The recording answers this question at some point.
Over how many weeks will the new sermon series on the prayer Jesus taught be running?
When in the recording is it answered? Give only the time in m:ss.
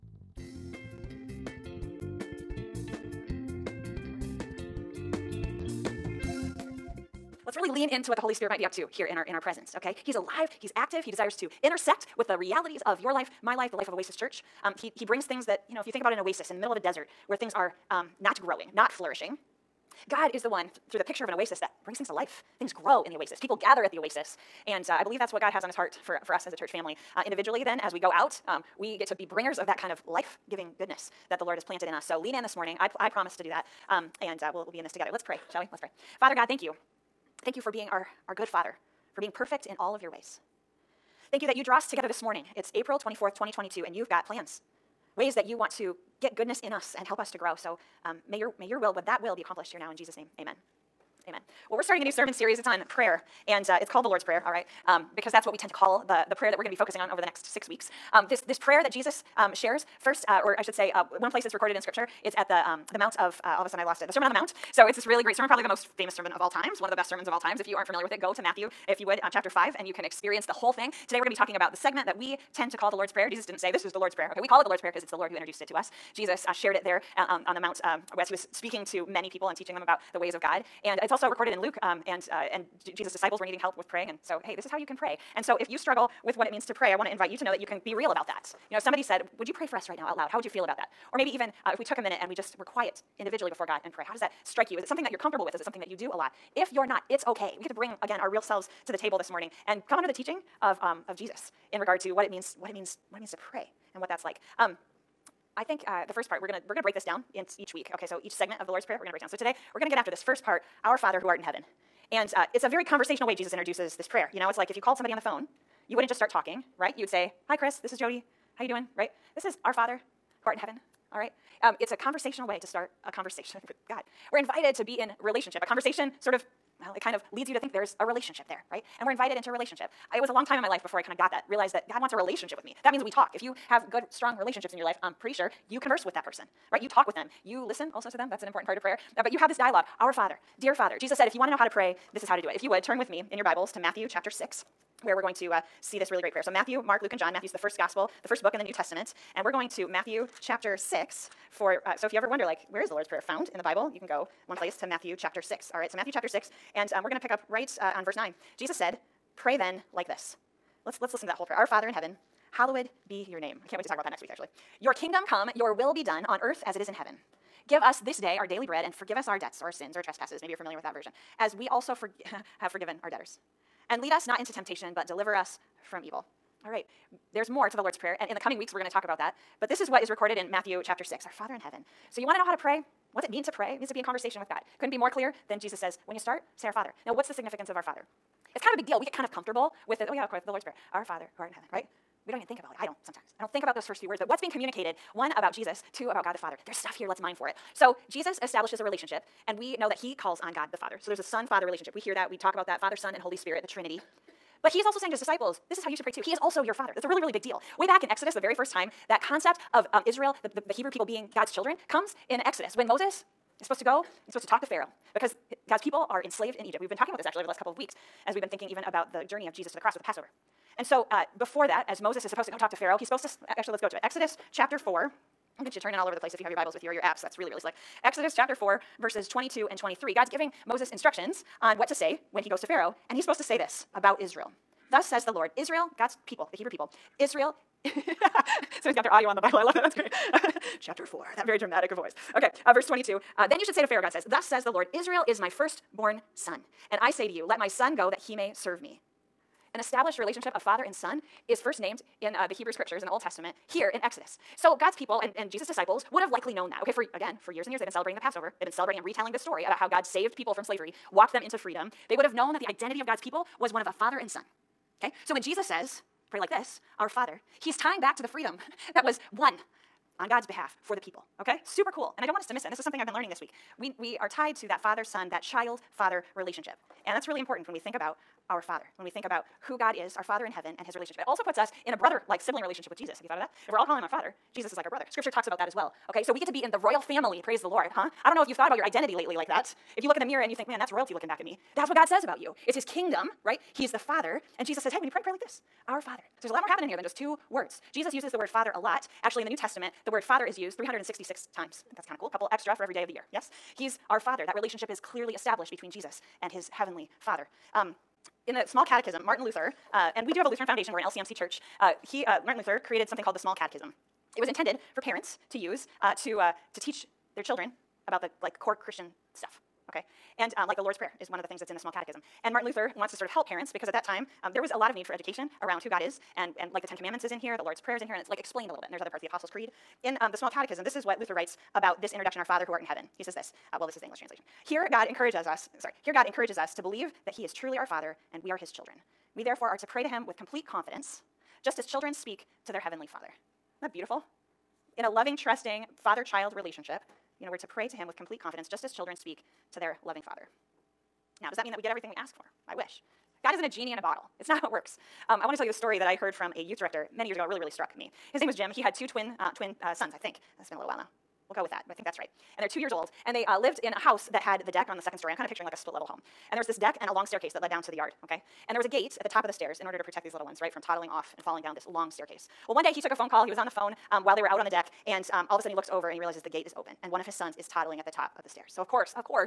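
0:57.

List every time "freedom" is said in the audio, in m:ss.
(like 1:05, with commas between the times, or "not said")
4:21, 4:28.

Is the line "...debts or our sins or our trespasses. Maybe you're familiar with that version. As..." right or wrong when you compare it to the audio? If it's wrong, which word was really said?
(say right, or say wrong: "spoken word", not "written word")
right.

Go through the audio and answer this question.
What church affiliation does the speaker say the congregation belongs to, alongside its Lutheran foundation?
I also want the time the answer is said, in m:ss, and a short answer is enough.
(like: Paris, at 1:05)
LCMC, at 5:11.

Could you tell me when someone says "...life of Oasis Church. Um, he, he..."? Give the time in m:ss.
0:13.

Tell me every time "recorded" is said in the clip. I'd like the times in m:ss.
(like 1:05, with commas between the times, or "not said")
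1:01, 1:21, 3:00.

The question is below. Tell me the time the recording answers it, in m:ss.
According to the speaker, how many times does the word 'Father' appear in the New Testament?
5:00.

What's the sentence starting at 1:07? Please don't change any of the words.
If you aren't familiar with it, go to Matthew, if you would, uh, chapter 5, and you can experience the whole thing.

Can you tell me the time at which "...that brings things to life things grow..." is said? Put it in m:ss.
0:21.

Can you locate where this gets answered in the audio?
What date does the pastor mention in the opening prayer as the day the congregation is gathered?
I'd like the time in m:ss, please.
0:42.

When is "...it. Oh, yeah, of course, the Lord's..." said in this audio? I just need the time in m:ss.
3:10.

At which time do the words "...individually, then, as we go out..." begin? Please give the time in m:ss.
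0:27.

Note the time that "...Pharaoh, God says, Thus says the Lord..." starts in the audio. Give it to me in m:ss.
4:03.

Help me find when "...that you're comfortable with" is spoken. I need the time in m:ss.
1:35.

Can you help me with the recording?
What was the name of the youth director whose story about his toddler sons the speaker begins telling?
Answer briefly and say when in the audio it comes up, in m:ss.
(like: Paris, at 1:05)
Jim, at 5:58.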